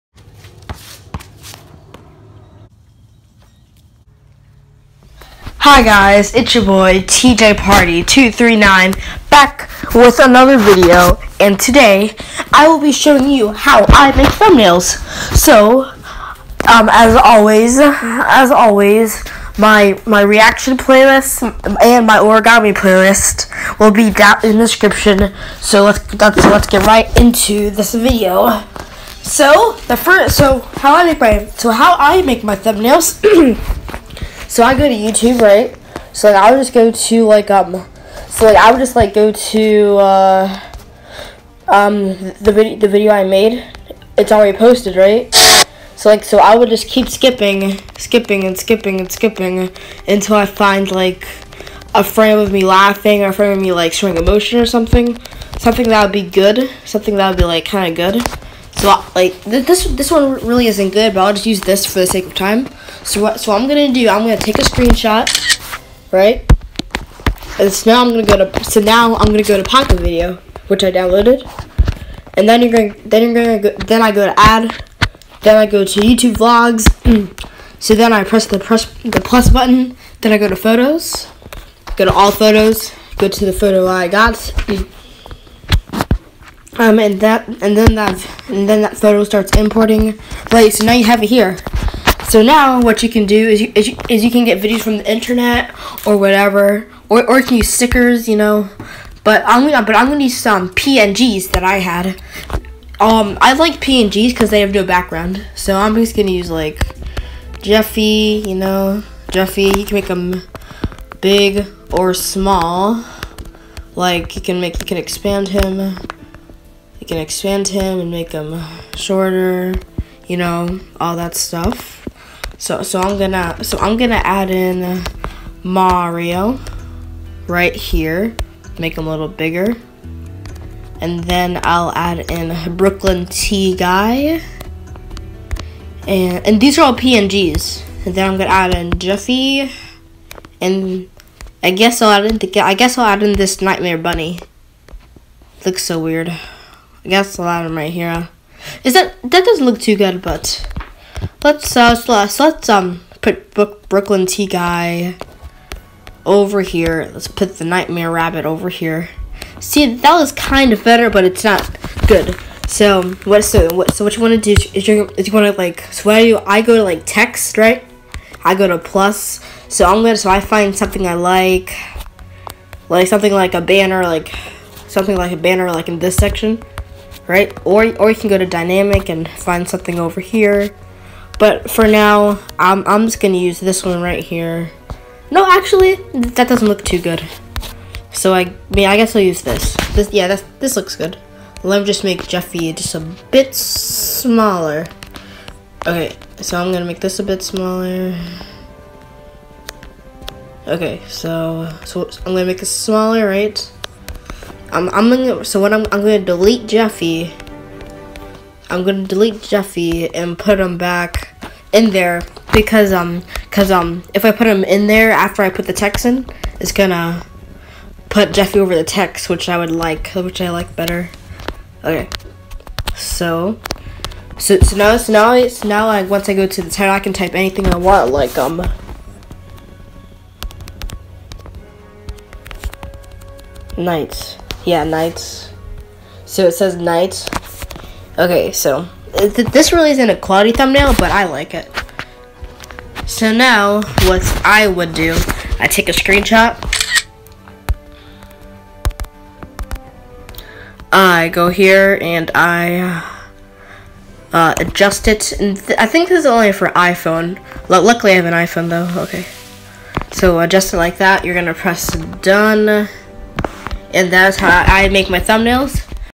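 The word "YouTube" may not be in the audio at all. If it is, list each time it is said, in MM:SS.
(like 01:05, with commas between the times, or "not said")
00:34, 01:15.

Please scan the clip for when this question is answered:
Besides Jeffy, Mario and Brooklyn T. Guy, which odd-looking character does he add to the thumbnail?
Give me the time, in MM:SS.
02:23.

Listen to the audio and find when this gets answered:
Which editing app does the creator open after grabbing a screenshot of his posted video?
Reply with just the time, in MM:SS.
01:09.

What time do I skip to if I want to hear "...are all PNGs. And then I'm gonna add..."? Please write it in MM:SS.
02:16.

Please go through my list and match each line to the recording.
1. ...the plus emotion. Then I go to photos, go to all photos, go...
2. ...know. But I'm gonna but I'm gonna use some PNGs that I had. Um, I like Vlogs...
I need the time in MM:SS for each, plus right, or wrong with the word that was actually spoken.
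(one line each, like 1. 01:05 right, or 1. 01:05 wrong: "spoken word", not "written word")
1. 01:19 wrong: "button", not "emotion"
2. 01:38 wrong: "PNGs", not "Vlogs".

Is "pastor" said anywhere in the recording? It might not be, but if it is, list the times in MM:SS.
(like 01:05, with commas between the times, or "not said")
not said.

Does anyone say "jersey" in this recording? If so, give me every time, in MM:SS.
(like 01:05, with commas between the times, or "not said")
not said.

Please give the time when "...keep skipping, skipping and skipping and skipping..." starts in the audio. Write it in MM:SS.
00:46.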